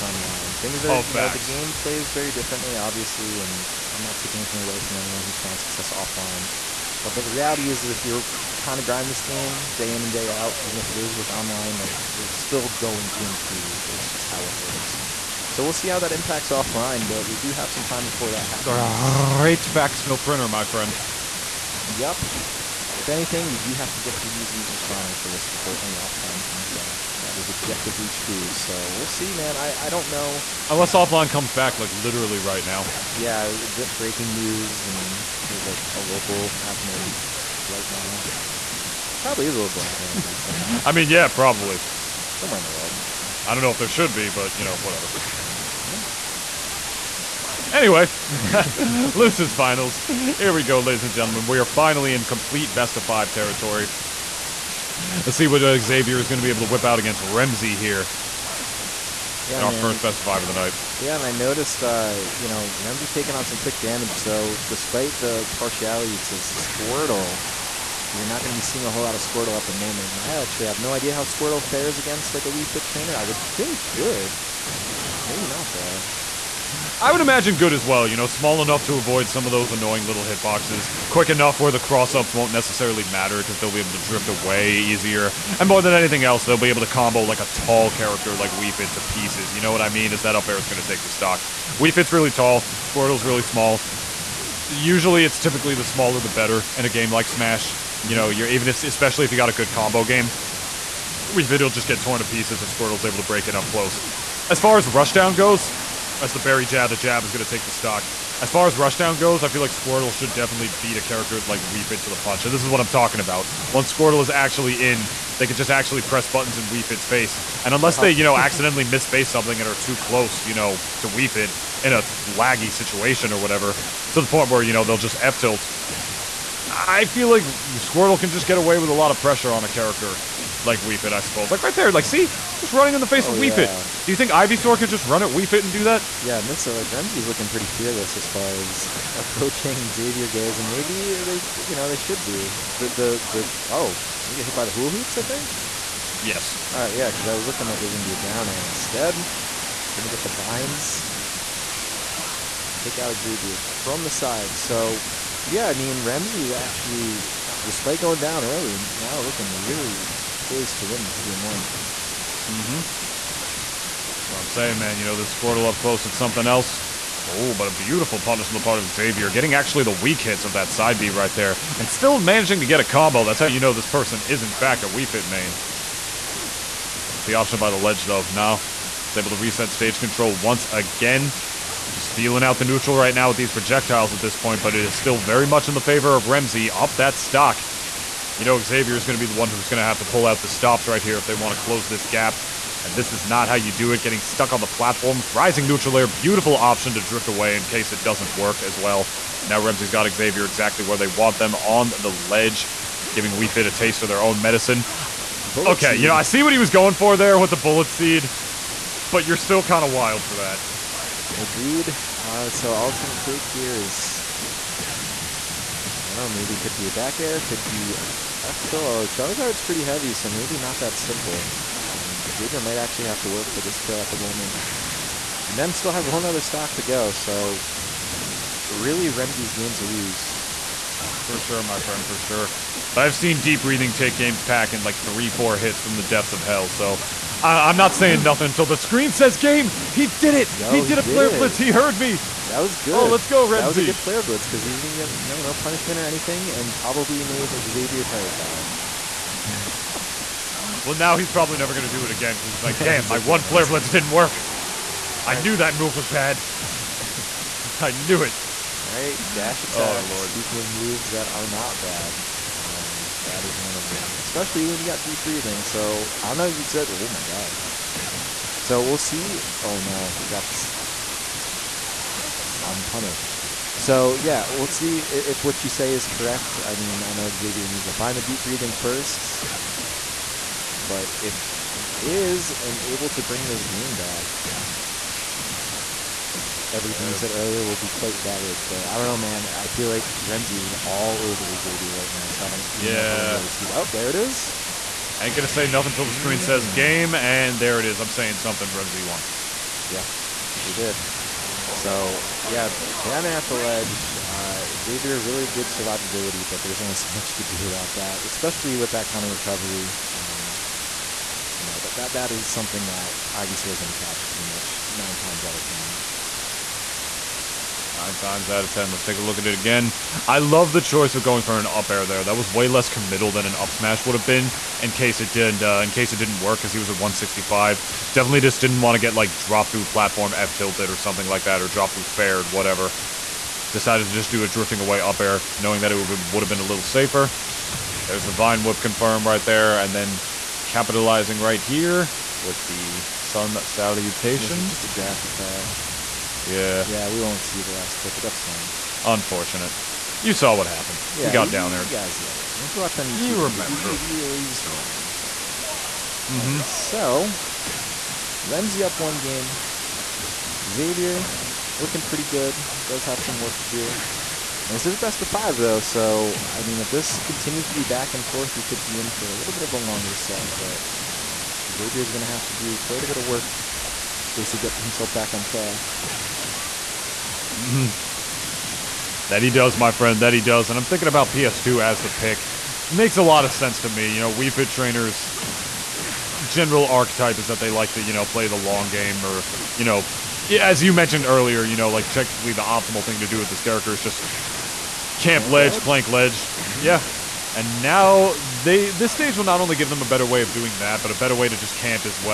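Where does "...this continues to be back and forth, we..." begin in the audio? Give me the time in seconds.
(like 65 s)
366 s.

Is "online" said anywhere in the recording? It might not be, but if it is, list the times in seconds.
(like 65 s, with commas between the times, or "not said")
0 s, 11 s.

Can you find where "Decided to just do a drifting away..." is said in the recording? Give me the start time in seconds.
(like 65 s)
333 s.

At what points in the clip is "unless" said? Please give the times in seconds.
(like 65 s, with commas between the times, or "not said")
30 s, 117 s.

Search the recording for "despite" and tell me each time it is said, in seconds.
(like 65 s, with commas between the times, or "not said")
64 s, 157 s.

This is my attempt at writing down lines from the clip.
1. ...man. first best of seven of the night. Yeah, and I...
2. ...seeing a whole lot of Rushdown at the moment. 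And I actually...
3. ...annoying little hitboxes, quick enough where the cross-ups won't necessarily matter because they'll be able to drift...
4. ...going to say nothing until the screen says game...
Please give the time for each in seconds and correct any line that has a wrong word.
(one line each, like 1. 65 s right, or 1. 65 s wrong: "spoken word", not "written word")
1. 59 s wrong: "five", not "seven"
2. 68 s wrong: "Squirtle", not "Rushdown"
3. 79 s right
4. 295 s right.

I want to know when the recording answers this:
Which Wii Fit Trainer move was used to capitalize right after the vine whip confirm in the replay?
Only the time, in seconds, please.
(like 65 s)
343 s.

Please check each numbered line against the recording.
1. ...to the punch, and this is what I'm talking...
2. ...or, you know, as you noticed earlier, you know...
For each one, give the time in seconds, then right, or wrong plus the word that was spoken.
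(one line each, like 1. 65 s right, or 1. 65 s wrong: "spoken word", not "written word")
1. 111 s right
2. 389 s wrong: "mentioned", not "noticed".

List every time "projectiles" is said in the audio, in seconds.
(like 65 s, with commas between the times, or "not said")
183 s.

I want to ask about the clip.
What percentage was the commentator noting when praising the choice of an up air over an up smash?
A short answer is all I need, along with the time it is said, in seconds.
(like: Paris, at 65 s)
165, at 326 s.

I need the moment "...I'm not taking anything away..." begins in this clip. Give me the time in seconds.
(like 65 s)
3 s.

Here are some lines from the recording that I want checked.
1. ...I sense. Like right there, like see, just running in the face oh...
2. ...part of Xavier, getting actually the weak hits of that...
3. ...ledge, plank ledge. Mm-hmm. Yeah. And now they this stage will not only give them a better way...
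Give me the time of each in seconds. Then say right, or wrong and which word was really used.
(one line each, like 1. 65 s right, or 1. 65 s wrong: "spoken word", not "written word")
1. 131 s wrong: "suppose", not "sense"
2. 168 s right
3. 395 s right.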